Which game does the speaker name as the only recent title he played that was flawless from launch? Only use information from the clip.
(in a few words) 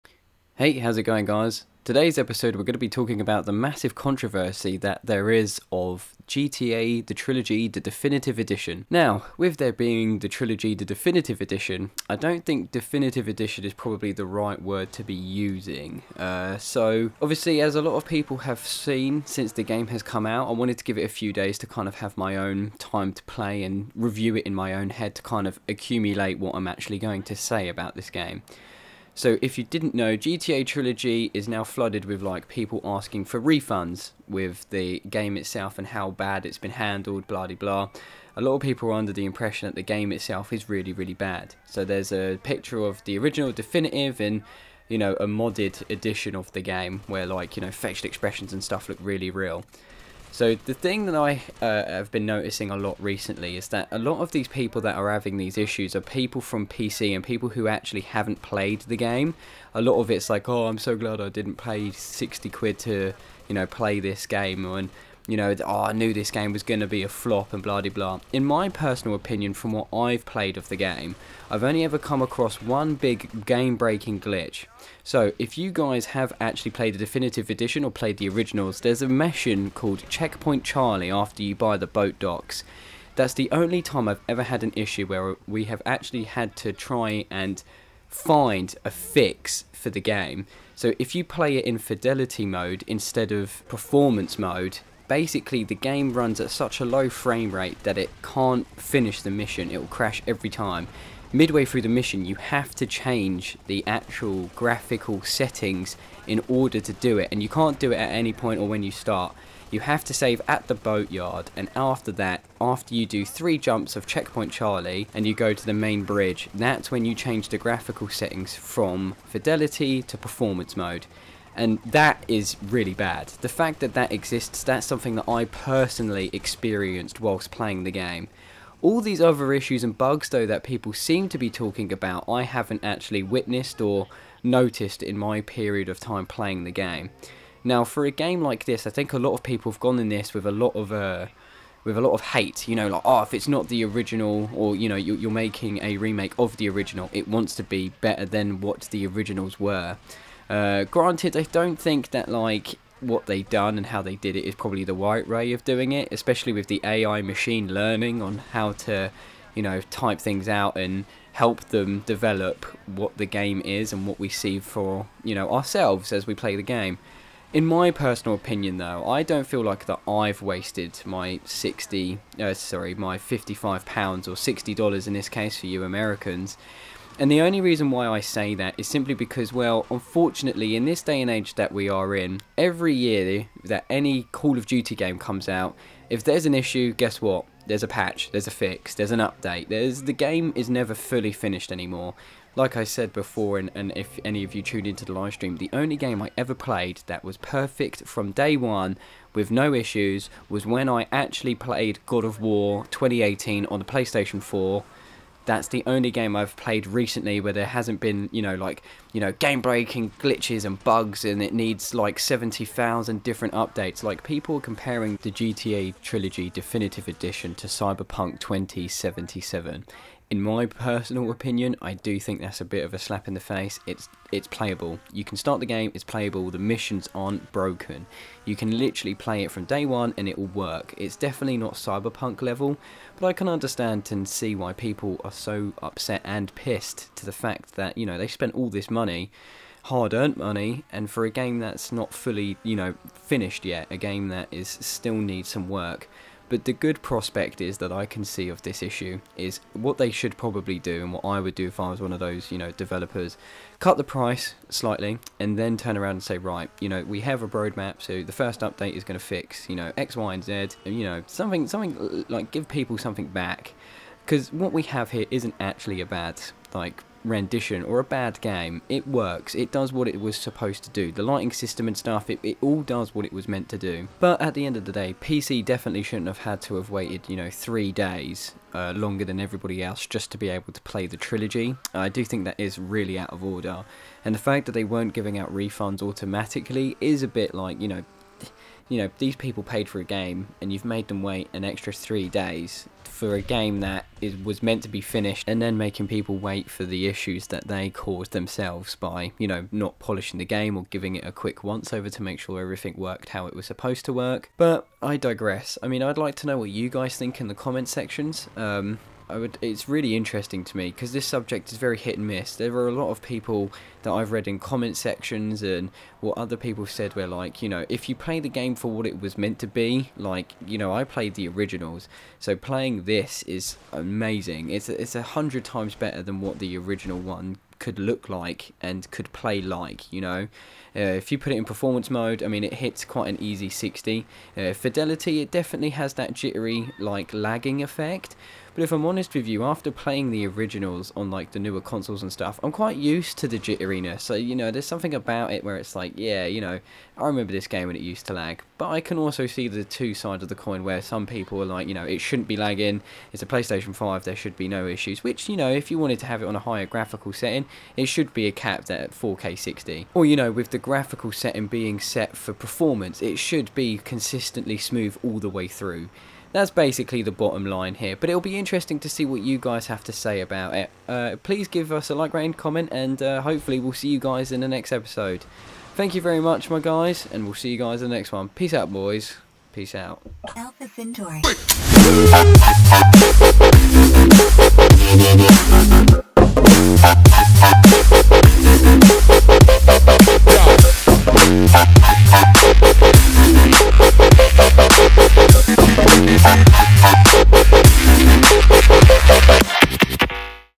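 God of War 2018.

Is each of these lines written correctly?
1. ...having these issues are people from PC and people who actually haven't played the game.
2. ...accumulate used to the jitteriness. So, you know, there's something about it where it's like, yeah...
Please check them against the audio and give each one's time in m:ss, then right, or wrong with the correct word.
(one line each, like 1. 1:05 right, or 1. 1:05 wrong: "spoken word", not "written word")
1. 0:55 right
2. 5:42 wrong: "quite", not "accumulate".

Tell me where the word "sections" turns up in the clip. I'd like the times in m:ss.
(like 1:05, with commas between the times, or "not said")
5:07, 5:14.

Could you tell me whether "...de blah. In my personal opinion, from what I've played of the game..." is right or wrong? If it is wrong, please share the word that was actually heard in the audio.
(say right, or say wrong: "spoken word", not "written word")
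right.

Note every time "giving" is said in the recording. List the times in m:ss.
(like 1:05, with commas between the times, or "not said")
4:45, 5:00.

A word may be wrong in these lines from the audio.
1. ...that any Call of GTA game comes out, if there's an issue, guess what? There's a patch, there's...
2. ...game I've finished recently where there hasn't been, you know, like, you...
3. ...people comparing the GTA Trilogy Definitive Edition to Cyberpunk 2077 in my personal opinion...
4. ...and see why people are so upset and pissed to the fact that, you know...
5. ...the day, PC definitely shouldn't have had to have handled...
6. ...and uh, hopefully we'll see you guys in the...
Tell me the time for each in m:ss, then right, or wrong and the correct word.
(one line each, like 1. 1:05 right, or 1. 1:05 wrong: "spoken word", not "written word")
1. 3:03 wrong: "Duty", not "GTA"
2. 3:26 wrong: "played", not "finished"
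3. 3:34 right
4. 3:54 right
5. 4:34 wrong: "waited", not "handled"
6. 6:12 right.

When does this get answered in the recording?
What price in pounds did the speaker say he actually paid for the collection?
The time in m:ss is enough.
2:53.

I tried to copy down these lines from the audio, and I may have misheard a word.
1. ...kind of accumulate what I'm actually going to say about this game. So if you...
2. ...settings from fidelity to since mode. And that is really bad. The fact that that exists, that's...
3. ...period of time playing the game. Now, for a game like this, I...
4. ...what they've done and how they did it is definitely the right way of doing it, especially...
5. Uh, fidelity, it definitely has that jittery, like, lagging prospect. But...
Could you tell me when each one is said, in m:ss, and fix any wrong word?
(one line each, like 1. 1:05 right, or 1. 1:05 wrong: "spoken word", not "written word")
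1. 0:25 right
2. 1:58 wrong: "performance", not "since"
3. 2:15 right
4. 2:32 wrong: "probably", not "definitely"
5. 5:34 wrong: "effect", not "prospect".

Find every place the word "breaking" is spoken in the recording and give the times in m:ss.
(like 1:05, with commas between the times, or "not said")
1:13, 3:29.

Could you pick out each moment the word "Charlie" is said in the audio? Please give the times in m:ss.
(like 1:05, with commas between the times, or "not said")
1:20, 1:54.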